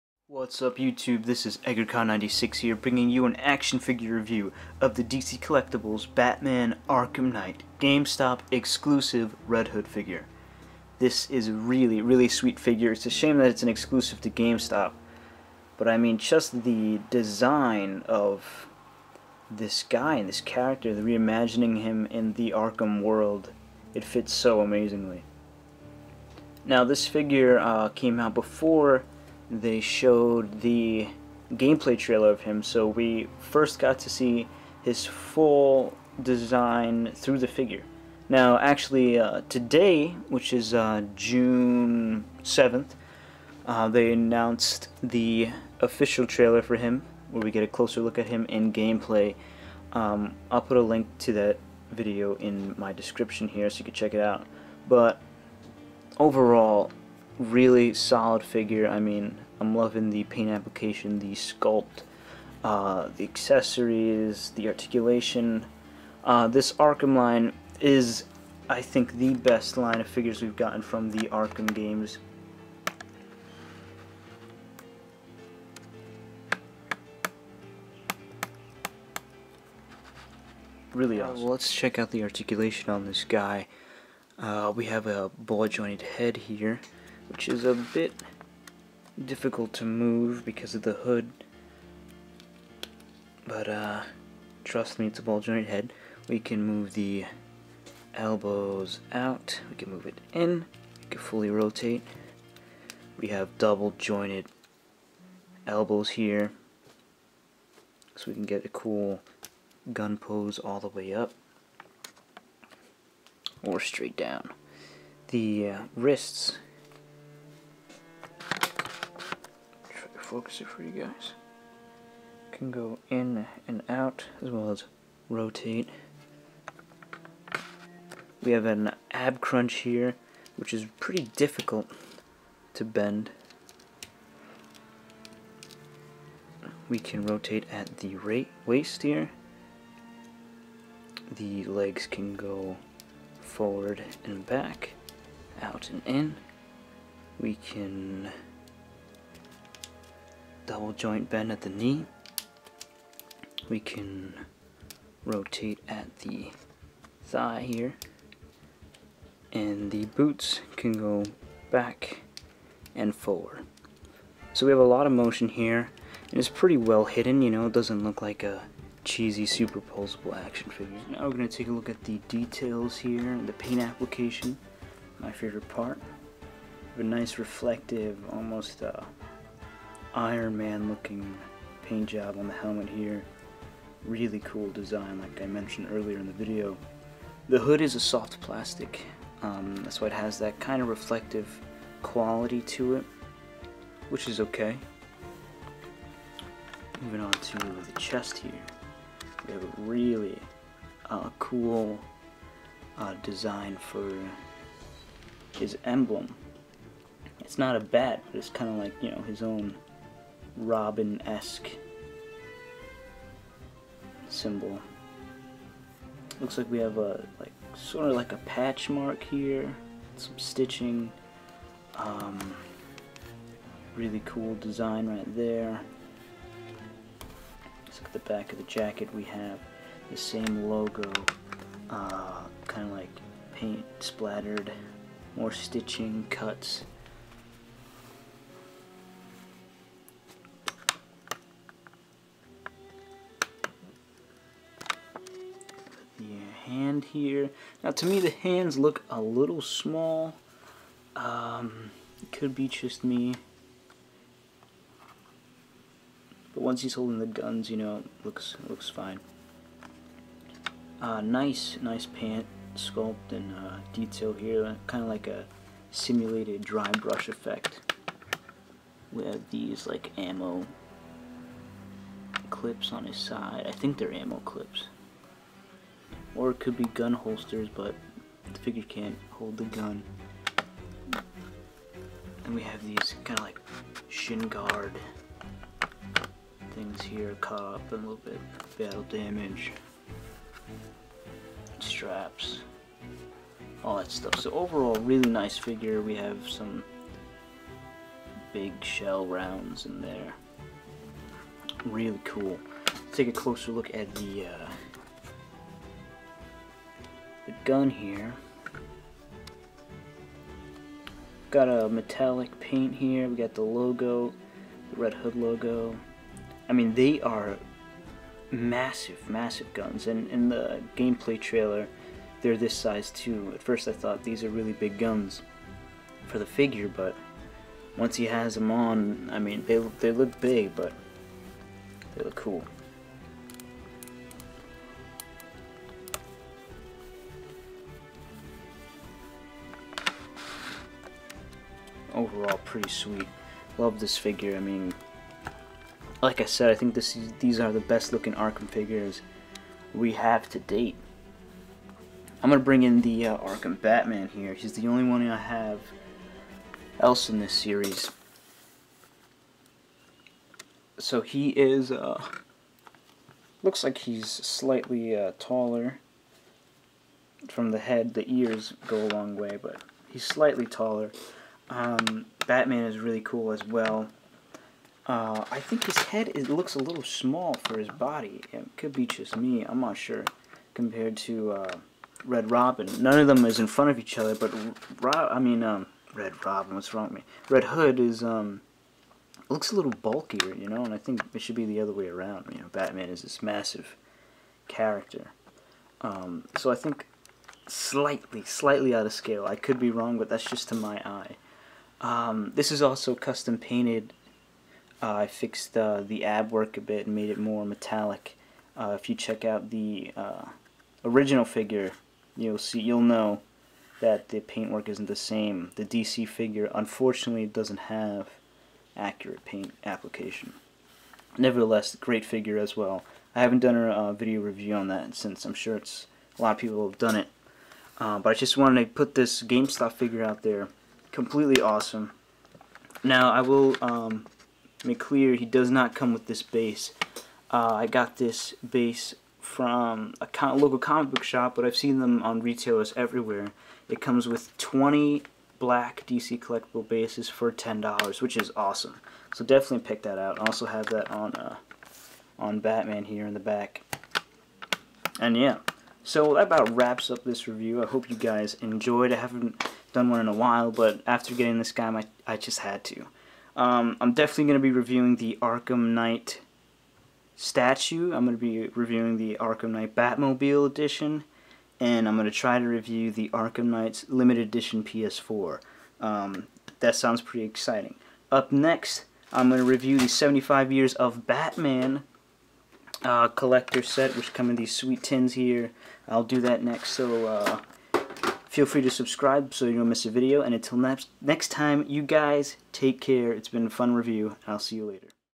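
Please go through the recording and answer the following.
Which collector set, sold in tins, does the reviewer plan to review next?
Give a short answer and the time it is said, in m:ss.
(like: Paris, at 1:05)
75 Years of Batman, at 8:00.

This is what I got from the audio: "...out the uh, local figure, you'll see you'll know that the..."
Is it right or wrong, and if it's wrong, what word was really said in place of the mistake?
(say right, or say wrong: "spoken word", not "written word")
wrong: "original", not "local".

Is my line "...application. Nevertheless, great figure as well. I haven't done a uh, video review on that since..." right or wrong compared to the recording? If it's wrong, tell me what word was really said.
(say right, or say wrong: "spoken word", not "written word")
right.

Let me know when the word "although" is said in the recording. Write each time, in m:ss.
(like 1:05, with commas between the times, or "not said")
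not said.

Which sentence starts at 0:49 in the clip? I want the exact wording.
Um, I'll put a link to that video in my description here so you can check it out.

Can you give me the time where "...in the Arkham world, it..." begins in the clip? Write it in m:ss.
0:22.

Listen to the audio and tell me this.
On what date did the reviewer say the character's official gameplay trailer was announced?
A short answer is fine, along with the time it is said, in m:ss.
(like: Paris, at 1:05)
June 7th, at 0:41.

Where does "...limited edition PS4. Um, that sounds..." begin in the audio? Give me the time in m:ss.
7:54.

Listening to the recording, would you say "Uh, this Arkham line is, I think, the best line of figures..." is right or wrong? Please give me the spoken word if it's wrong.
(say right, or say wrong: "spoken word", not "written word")
right.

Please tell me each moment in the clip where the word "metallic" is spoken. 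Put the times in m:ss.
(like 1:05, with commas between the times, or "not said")
5:11, 6:47.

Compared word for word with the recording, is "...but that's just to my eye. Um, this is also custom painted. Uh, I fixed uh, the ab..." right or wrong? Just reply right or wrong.
right.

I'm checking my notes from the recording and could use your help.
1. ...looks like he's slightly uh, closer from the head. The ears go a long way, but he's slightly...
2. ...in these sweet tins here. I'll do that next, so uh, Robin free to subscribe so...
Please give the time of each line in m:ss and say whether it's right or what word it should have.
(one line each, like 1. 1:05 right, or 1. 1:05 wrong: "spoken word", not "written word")
1. 6:03 wrong: "taller", not "closer"
2. 8:04 wrong: "Feel", not "Robin".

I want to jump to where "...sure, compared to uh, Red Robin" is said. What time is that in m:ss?
6:19.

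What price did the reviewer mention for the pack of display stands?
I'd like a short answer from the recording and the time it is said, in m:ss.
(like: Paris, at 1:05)
$10, at 7:27.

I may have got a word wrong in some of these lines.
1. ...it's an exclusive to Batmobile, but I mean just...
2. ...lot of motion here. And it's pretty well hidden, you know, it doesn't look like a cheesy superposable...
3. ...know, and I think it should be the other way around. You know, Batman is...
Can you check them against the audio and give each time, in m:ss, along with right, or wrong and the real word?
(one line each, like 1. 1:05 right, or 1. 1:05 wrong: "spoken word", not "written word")
1. 0:13 wrong: "GameStop", not "Batmobile"
2. 2:44 right
3. 6:30 right.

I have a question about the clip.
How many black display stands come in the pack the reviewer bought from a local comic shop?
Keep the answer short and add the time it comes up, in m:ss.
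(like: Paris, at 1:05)
20, at 7:24.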